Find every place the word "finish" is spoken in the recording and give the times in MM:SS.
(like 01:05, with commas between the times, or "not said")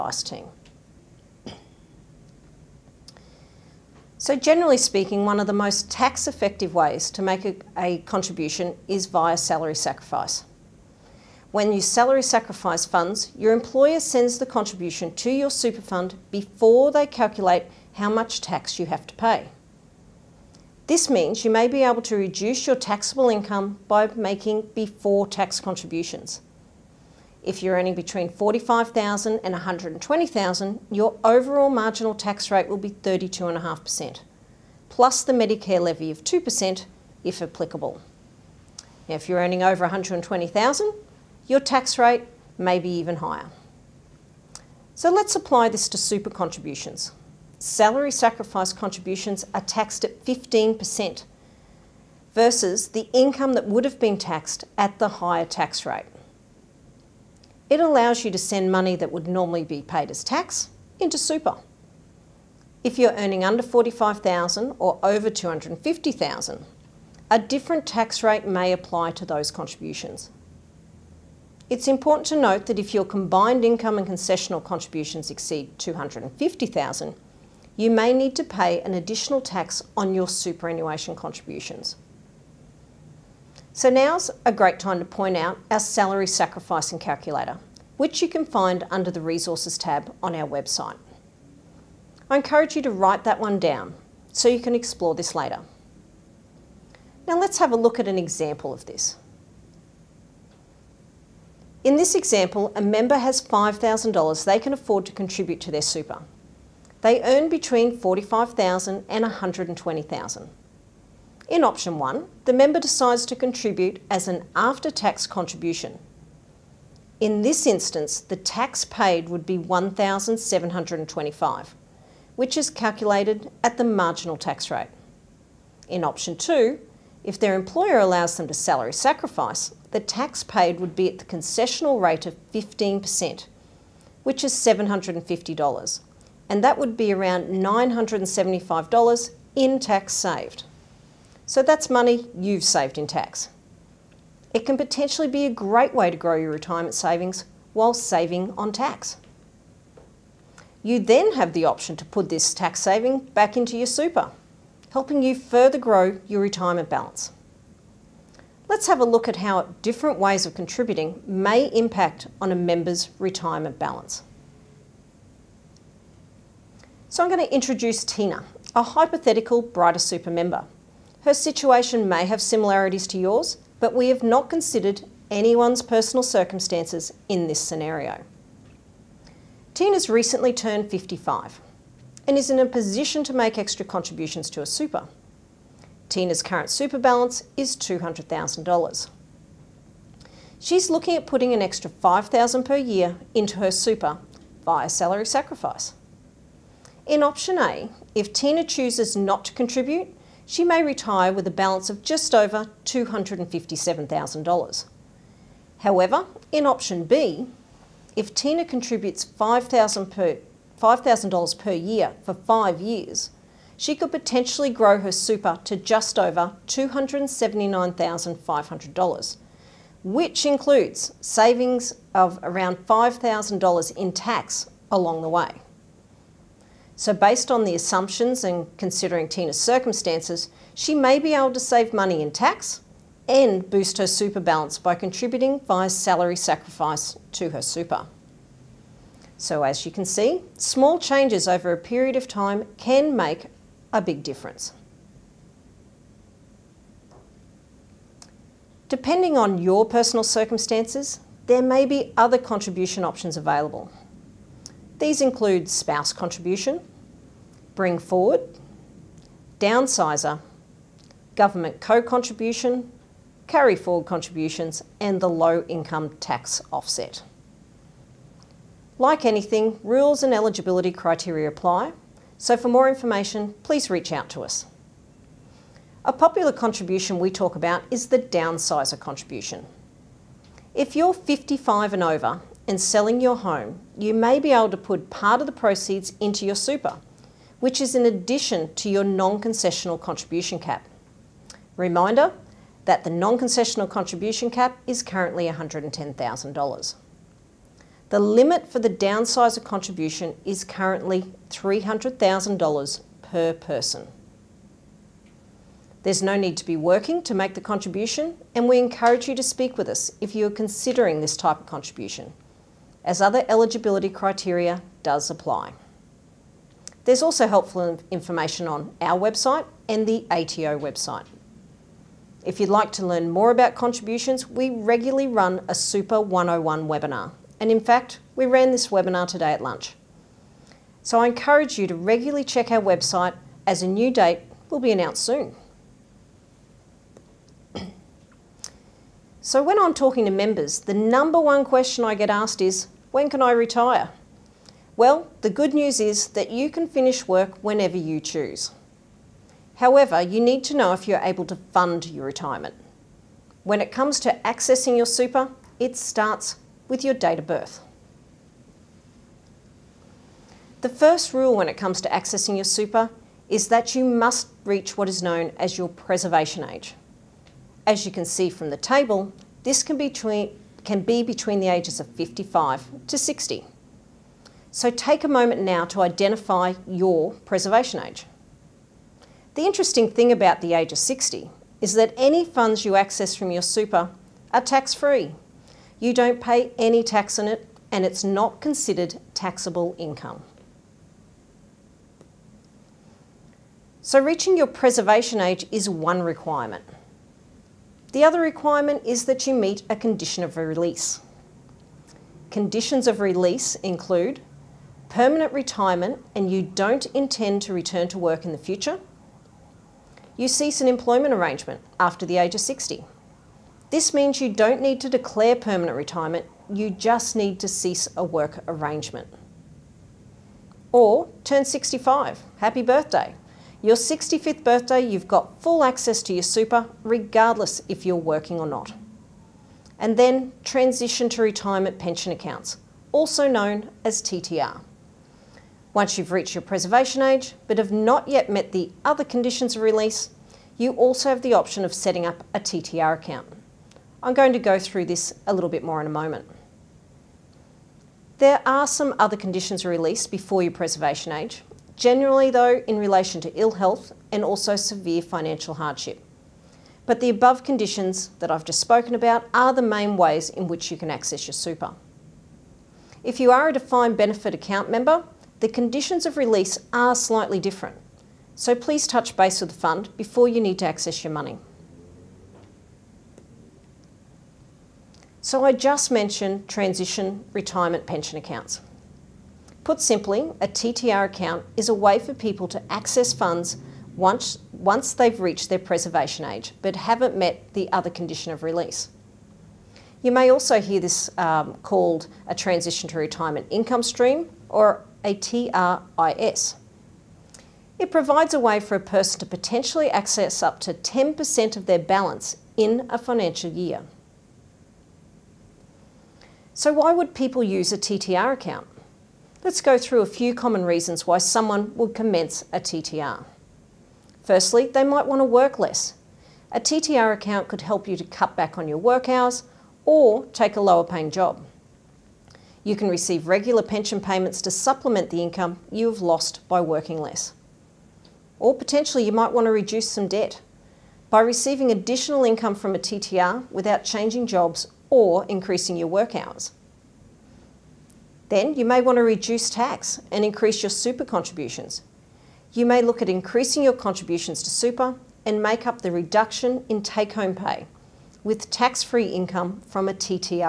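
05:46.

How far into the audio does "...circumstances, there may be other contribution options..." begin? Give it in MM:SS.
04:10.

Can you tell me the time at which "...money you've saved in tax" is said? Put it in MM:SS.
02:21.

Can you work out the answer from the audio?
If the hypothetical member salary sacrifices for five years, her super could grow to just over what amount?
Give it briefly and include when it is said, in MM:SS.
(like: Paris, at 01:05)
$279,500, at 03:36.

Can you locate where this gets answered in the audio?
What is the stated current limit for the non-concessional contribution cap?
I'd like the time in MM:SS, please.
04:55.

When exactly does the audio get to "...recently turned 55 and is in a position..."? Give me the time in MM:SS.
03:00.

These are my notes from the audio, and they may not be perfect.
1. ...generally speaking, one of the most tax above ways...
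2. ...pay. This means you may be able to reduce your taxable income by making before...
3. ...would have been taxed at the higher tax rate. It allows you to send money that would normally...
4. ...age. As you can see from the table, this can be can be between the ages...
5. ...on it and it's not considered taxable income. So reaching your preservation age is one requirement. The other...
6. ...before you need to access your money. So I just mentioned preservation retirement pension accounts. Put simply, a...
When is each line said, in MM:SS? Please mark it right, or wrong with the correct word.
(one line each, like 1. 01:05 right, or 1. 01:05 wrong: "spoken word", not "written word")
1. 00:04 wrong: "effective", not "above"
2. 00:19 right
3. 00:53 right
4. 06:06 right
5. 06:27 right
6. 07:50 wrong: "transition", not "preservation".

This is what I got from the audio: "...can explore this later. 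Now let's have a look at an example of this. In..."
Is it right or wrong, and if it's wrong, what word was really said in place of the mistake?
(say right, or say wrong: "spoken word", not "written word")
right.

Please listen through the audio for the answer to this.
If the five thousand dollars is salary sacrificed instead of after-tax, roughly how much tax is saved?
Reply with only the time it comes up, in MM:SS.
02:17.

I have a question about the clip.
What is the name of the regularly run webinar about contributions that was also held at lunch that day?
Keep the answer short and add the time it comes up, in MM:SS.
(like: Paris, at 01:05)
Super 101, at 05:25.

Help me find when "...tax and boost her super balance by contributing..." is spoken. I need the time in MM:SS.
03:52.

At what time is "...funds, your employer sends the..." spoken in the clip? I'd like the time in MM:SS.
00:12.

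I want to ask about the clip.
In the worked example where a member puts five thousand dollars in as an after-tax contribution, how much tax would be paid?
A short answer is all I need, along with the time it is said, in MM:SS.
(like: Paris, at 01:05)
$1,725, at 01:59.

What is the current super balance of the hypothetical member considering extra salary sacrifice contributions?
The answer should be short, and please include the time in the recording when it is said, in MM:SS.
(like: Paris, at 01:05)
$200,000, at 03:07.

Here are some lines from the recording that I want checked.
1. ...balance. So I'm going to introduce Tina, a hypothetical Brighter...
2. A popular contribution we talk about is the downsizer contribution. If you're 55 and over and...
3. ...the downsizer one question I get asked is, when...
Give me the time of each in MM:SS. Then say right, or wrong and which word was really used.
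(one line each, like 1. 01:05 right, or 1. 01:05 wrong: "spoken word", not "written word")
1. 02:43 right
2. 04:36 right
3. 05:40 wrong: "number", not "downsizer".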